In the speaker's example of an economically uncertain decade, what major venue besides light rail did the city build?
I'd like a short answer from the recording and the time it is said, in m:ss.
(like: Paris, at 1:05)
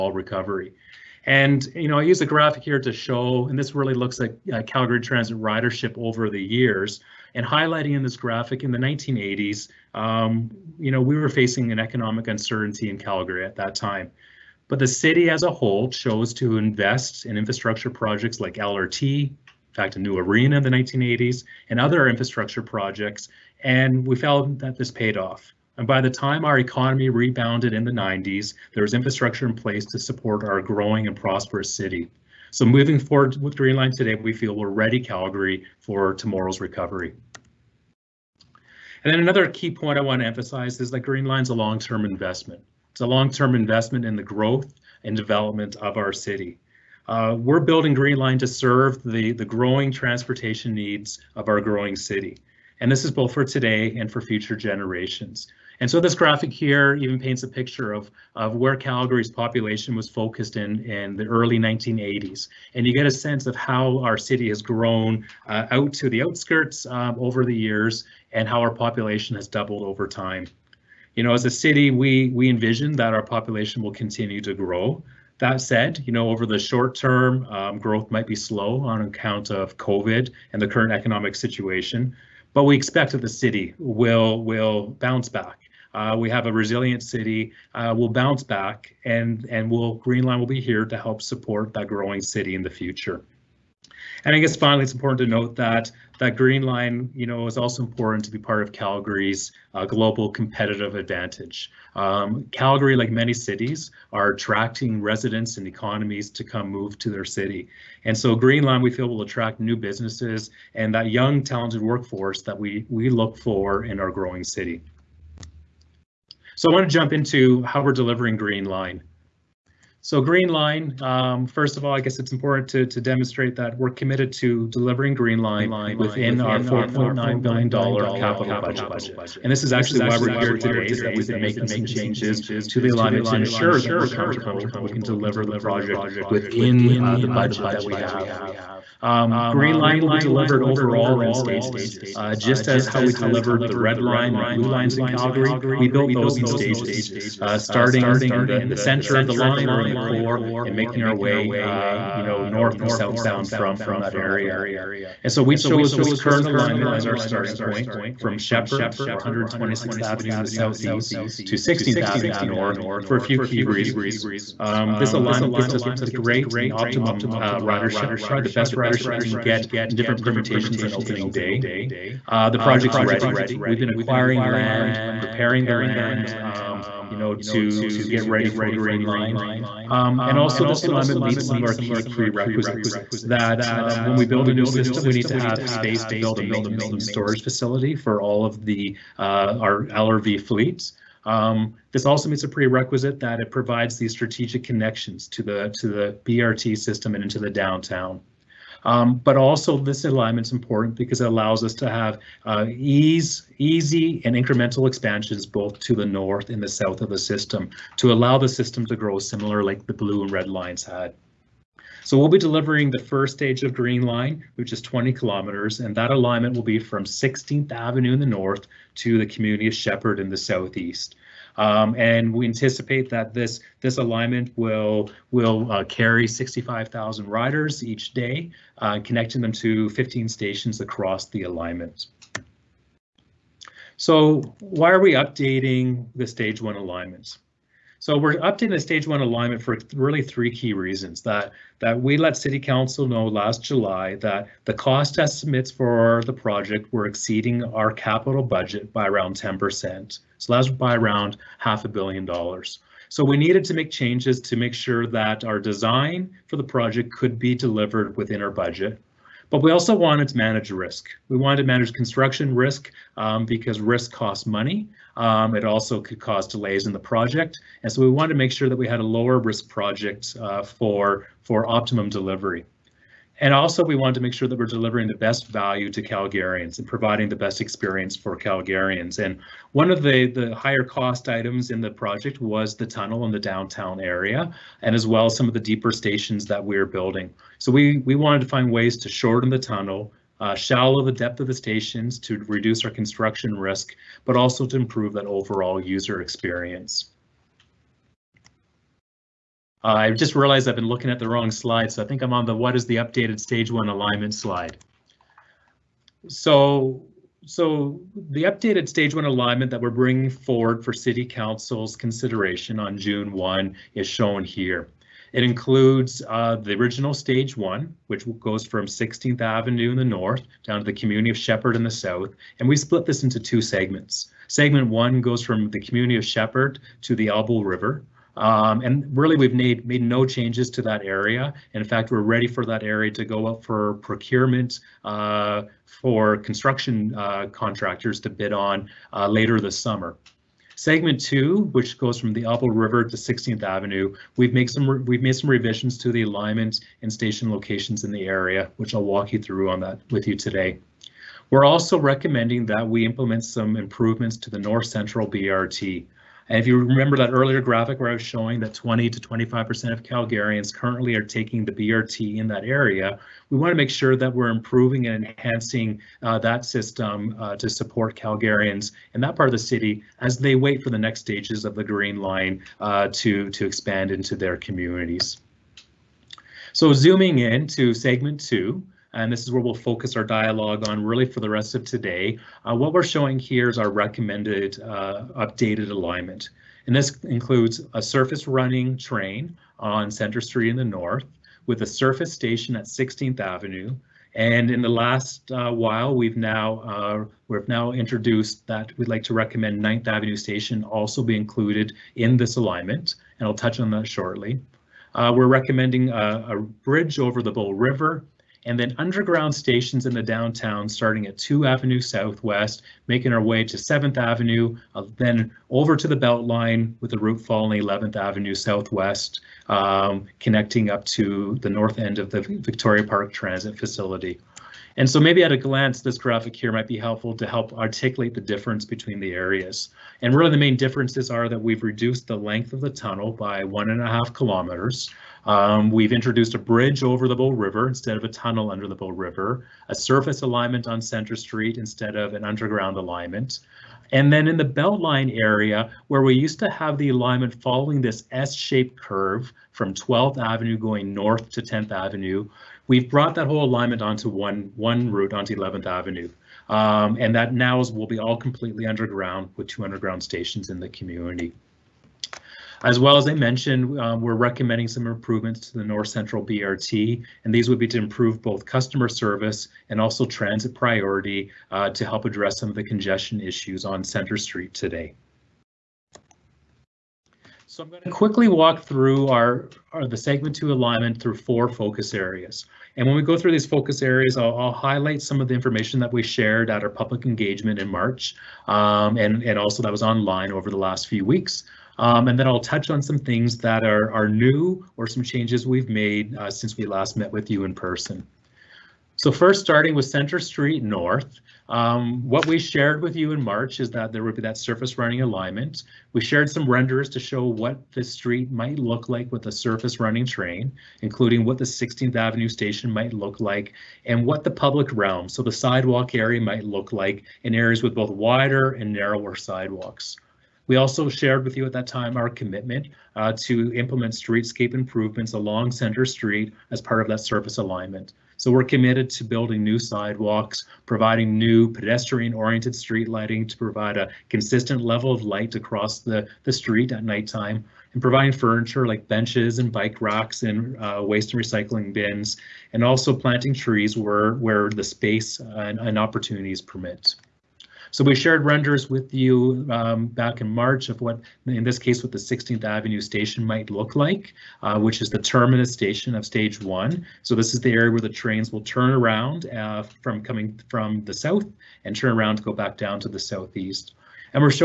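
A new arena, at 0:19.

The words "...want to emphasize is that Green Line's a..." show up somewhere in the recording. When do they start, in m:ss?
0:40.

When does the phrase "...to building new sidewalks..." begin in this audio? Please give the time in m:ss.
8:49.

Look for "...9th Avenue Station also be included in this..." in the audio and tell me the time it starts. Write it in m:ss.
6:39.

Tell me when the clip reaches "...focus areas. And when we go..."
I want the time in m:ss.
8:01.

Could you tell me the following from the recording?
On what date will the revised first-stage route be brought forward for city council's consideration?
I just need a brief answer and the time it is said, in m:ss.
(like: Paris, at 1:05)
June 1, at 5:12.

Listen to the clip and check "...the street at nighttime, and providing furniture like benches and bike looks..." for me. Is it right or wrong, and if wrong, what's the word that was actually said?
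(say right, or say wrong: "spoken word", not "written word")
wrong: "racks", not "looks".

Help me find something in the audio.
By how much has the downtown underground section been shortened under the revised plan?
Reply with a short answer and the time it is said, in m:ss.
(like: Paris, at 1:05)
1.5 kilometers, at 7:13.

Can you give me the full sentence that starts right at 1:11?
You know, as a city, we, we envision that our population will continue to grow.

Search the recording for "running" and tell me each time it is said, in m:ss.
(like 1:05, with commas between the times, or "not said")
6:28, 8:24, 8:29.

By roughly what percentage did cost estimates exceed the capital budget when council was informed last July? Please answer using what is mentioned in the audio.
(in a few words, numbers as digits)
10%.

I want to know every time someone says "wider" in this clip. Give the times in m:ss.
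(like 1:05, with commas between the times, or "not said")
8:38.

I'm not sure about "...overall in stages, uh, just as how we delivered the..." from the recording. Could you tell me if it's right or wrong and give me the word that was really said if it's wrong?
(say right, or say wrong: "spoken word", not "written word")
right.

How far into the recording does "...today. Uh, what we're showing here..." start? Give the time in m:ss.
6:21.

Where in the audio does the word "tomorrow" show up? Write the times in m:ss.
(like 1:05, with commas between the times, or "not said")
0:36.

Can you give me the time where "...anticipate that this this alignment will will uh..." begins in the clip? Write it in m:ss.
3:42.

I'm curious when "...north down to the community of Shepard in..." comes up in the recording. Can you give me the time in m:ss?
5:20.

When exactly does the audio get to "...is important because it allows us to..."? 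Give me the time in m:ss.
3:20.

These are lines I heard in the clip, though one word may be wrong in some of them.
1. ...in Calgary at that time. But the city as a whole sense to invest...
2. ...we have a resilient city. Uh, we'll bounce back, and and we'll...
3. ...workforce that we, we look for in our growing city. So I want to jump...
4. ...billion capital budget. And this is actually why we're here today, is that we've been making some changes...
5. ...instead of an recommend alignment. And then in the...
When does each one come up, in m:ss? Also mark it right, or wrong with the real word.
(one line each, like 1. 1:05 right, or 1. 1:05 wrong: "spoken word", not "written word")
1. 0:12 wrong: "chose", not "sense"
2. 1:26 right
3. 1:51 right
4. 2:07 right
5. 7:21 wrong: "underground", not "recommend".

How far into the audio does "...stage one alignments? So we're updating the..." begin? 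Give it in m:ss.
3:56.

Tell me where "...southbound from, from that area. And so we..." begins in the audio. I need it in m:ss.
2:32.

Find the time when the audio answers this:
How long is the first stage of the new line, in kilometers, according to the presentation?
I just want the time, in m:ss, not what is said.
3:34.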